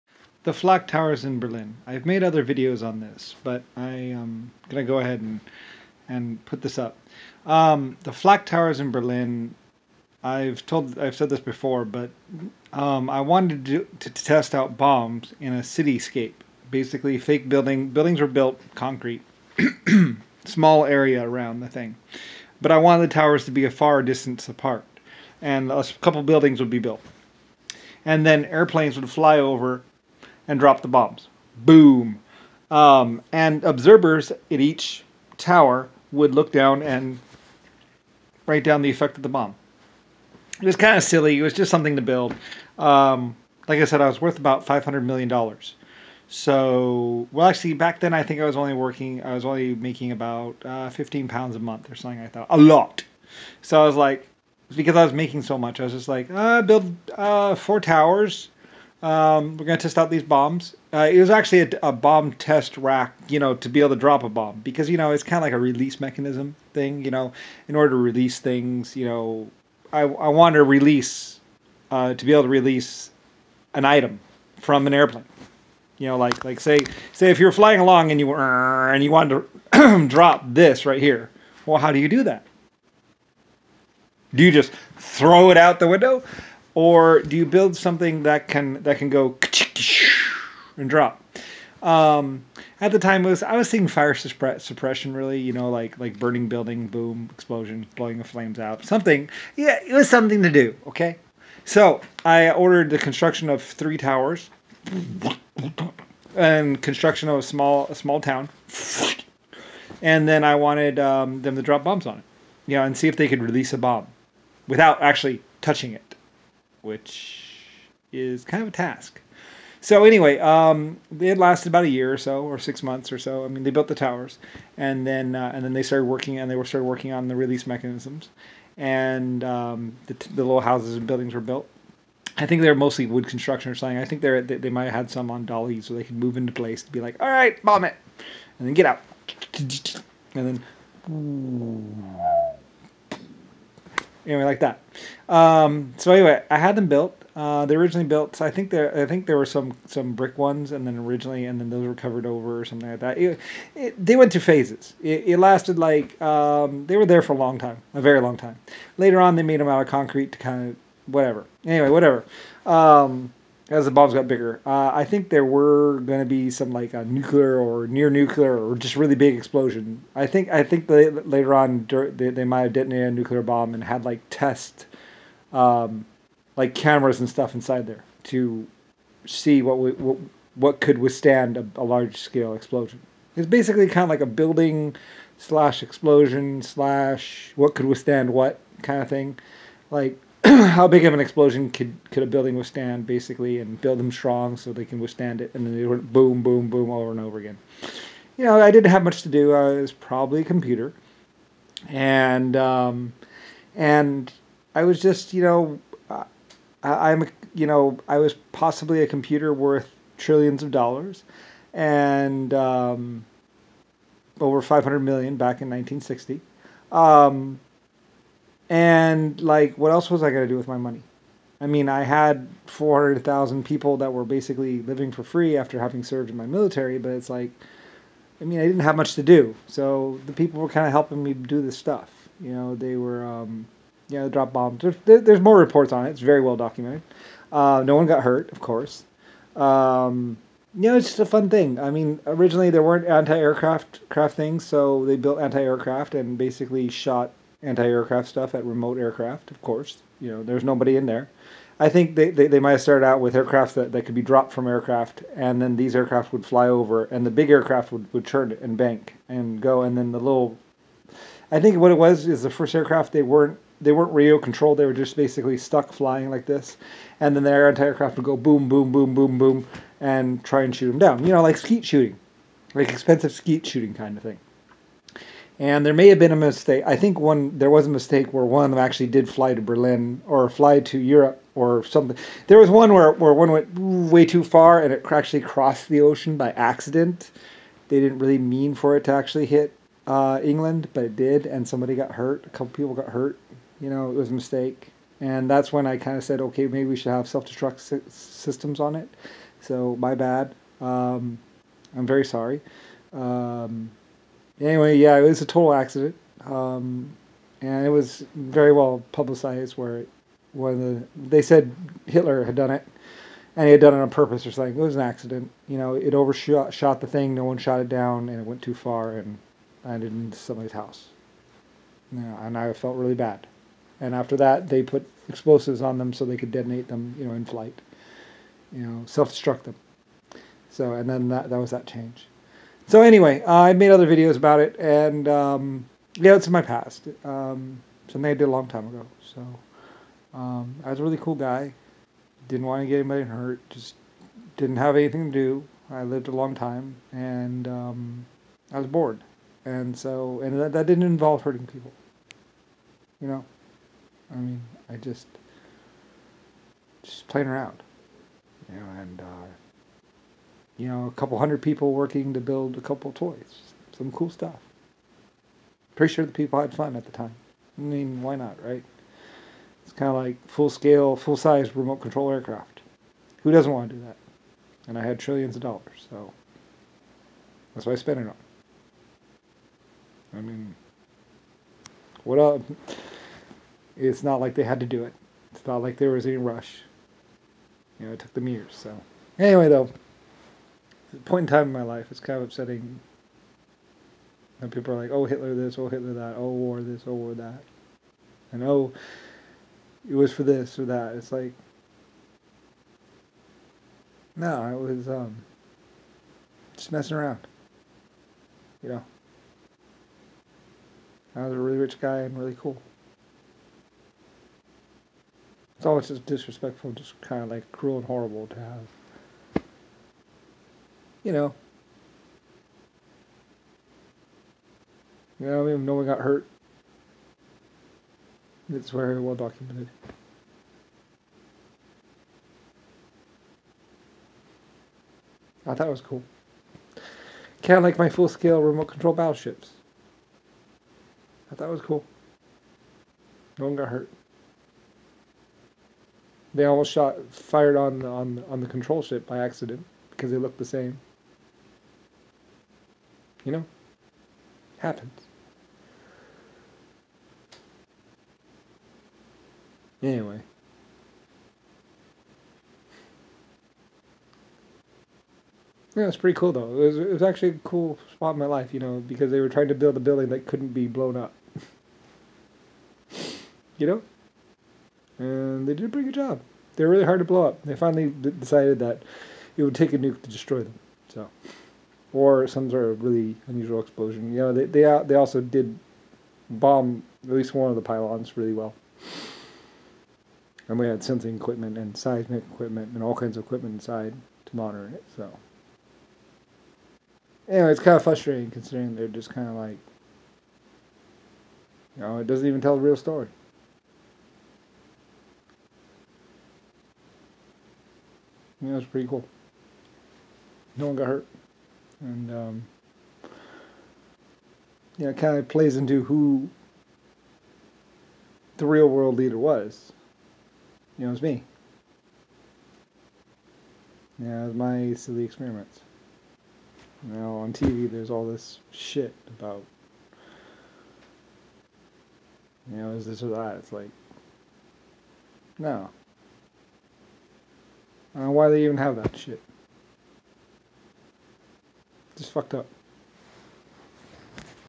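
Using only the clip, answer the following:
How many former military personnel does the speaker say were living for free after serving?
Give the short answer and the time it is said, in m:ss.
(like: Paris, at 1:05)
400,000, at 3:42.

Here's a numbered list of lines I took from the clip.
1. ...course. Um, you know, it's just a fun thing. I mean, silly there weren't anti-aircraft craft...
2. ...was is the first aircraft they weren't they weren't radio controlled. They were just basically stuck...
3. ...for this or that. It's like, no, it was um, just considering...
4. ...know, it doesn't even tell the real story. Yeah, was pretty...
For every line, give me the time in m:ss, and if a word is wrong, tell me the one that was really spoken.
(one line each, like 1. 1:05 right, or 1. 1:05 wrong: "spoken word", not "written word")
1. 3:58 wrong: "originally", not "silly"
2. 4:21 right
3. 6:40 wrong: "messing", not "considering"
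4. 8:22 right.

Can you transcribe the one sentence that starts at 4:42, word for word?
There was one where, where one went way too far and it actually crossed the ocean by accident.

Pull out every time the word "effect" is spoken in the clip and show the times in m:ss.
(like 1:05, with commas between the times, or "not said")
0:38.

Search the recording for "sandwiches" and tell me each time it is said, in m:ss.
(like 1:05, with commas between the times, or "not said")
not said.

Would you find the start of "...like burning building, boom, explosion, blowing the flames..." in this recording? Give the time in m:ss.
1:35.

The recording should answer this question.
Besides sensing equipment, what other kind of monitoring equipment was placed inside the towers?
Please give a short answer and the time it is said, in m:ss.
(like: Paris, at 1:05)
Seismic equipment, at 8:11.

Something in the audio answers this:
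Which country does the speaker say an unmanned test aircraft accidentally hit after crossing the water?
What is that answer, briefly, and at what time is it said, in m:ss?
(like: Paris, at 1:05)
England, at 4:50.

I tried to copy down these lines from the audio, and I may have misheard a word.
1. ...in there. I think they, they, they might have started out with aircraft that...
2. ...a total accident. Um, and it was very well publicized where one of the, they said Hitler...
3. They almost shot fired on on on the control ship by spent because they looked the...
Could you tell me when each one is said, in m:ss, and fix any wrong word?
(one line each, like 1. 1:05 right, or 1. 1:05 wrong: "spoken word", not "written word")
1. 4:10 right
2. 5:05 right
3. 7:26 wrong: "accident", not "spent".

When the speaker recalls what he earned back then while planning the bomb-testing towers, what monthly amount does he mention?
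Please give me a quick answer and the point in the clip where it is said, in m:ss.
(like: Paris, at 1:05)
15 pounds, at 0:50.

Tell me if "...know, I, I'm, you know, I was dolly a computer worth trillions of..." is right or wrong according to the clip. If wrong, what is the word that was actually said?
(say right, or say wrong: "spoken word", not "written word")
wrong: "possibly", not "dolly".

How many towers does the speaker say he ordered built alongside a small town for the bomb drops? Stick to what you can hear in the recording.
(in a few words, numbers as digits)
3.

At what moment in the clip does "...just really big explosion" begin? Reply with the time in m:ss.
2:48.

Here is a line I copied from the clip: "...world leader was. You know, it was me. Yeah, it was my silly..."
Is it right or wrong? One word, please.
right.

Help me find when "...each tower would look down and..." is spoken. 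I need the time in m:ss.
0:34.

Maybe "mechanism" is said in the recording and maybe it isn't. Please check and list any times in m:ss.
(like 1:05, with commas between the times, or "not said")
1:05, 2:07.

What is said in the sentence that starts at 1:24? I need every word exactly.
Do you just throw it out the window?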